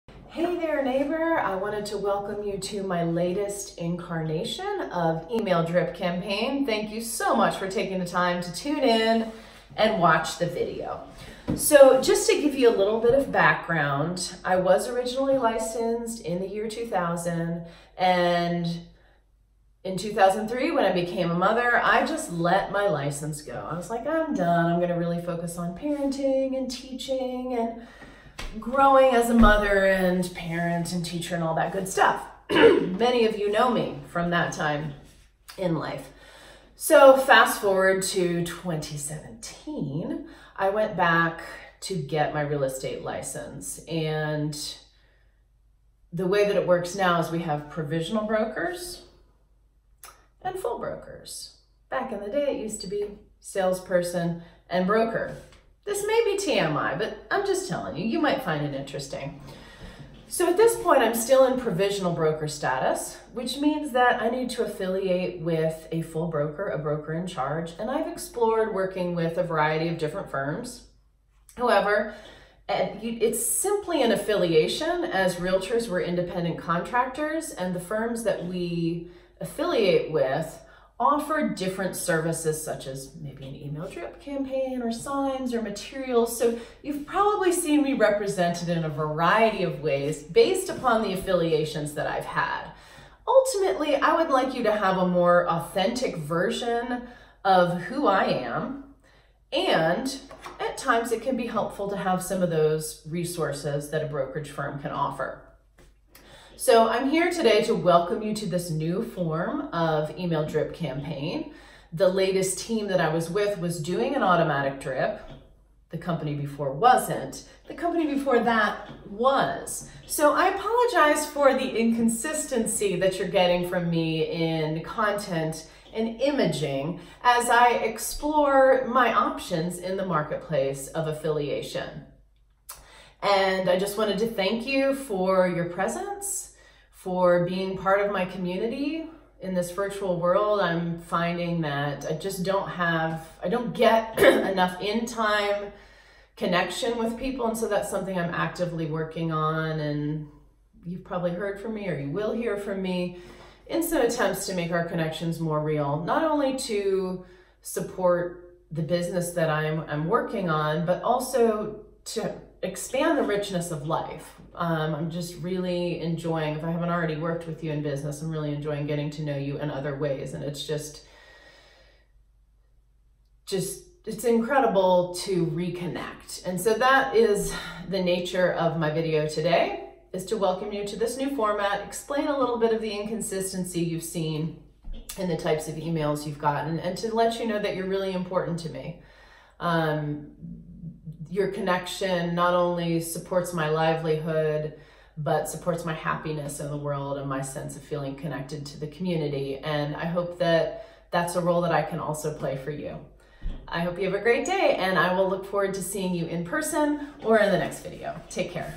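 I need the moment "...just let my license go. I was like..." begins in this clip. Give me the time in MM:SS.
00:22.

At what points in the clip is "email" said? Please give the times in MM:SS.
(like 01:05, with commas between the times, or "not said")
00:05, 01:23, 01:50, 03:05.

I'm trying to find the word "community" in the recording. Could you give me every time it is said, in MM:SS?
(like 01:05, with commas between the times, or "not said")
02:18, 03:18.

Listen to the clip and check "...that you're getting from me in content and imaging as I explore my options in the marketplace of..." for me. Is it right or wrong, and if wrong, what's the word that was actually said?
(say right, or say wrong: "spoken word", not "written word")
right.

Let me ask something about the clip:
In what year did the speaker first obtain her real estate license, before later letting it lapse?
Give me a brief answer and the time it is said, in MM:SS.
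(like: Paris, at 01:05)
2000, at 00:16.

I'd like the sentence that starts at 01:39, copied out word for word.
And at times it can be helpful to have some of those resources that a brokerage firm can offer.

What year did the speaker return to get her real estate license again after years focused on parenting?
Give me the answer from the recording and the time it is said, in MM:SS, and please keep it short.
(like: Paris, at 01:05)
2017, at 00:38.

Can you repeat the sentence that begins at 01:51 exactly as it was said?
The latest team that I was with was doing an automatic drip.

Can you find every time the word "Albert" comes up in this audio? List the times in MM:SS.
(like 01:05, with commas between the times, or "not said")
not said.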